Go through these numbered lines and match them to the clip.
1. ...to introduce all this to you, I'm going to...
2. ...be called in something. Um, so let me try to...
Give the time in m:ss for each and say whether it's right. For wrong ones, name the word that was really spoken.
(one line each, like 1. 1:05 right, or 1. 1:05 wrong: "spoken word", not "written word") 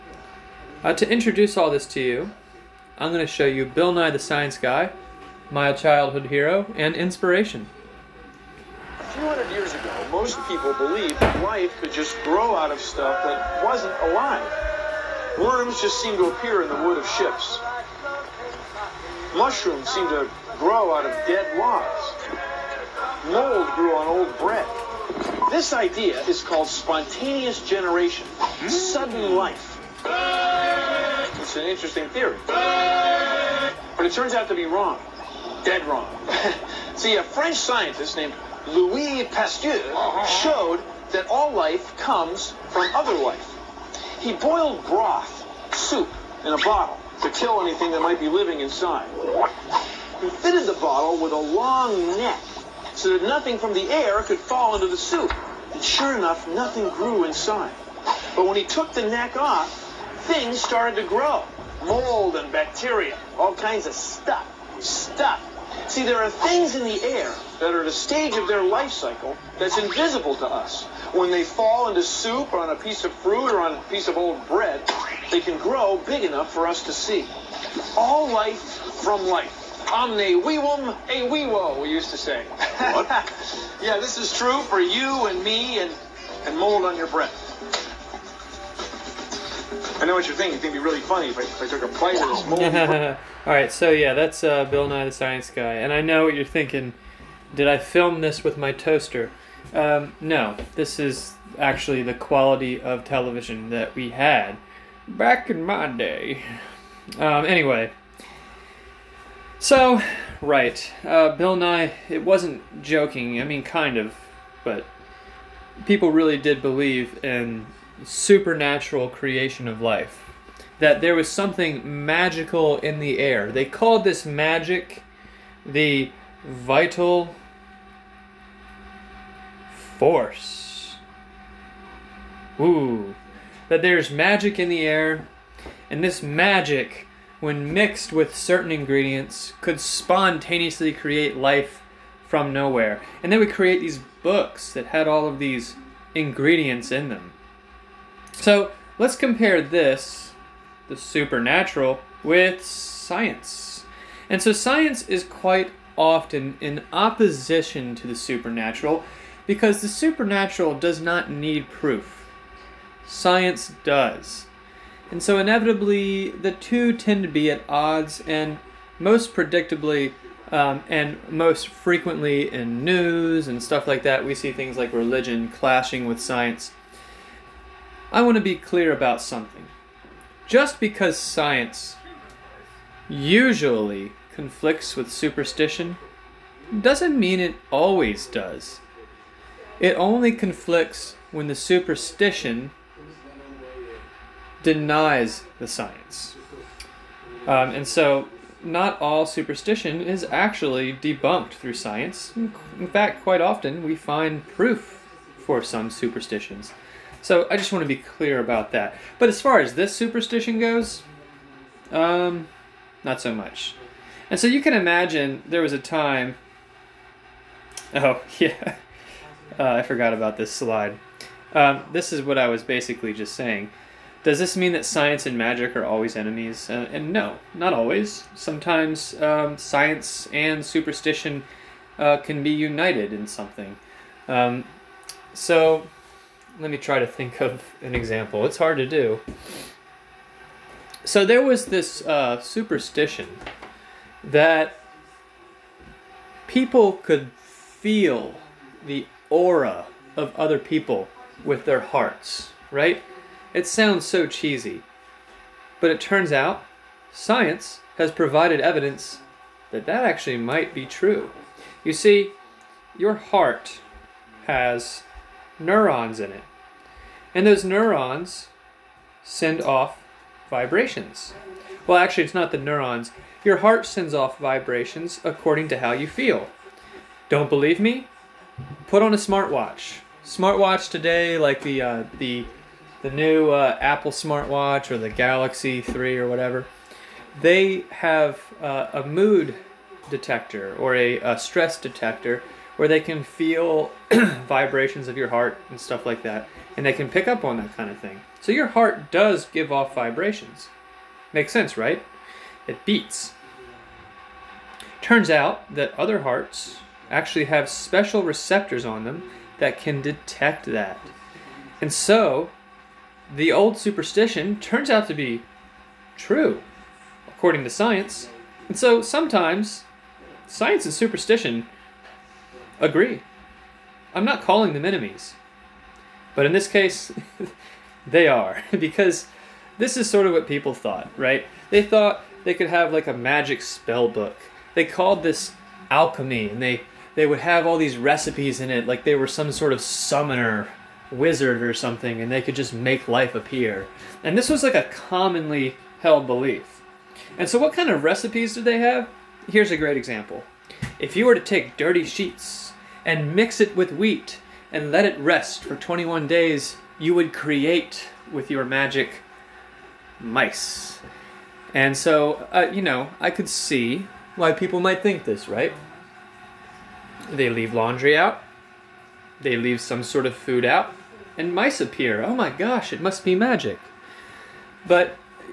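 1. 0:00 right
2. 3:52 wrong: "united", not "called".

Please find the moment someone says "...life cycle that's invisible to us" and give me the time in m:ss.
1:08.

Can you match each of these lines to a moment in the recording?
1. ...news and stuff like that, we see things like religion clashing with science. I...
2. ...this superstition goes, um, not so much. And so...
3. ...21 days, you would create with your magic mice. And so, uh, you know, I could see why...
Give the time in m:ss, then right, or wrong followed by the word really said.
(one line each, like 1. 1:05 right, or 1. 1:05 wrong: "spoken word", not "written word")
1. 2:52 right
2. 3:29 right
3. 5:55 right.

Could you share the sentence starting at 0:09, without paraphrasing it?
years most people believe that life could just grow out of stuff that wasn't alive.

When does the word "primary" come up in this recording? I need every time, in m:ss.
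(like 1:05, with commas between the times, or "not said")
not said.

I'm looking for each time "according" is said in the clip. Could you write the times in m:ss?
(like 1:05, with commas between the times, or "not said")
4:35, 5:17.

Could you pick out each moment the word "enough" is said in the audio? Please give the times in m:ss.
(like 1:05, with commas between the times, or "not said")
0:56, 1:16.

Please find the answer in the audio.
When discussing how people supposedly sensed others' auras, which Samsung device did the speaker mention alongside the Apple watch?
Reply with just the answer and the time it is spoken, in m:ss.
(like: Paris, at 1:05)
Galaxy 3, at 4:45.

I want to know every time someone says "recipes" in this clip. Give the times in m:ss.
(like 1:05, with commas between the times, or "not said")
5:37, 5:48.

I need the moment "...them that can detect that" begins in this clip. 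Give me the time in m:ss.
5:09.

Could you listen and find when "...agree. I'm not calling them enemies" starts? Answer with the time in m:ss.
5:22.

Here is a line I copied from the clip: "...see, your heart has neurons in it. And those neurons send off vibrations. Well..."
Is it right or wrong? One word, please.
right.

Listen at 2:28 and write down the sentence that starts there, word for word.
So let's compare this, the supernatural, with science.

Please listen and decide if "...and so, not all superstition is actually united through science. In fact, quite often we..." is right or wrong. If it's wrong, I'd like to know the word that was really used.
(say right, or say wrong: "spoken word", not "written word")
wrong: "debunked", not "united".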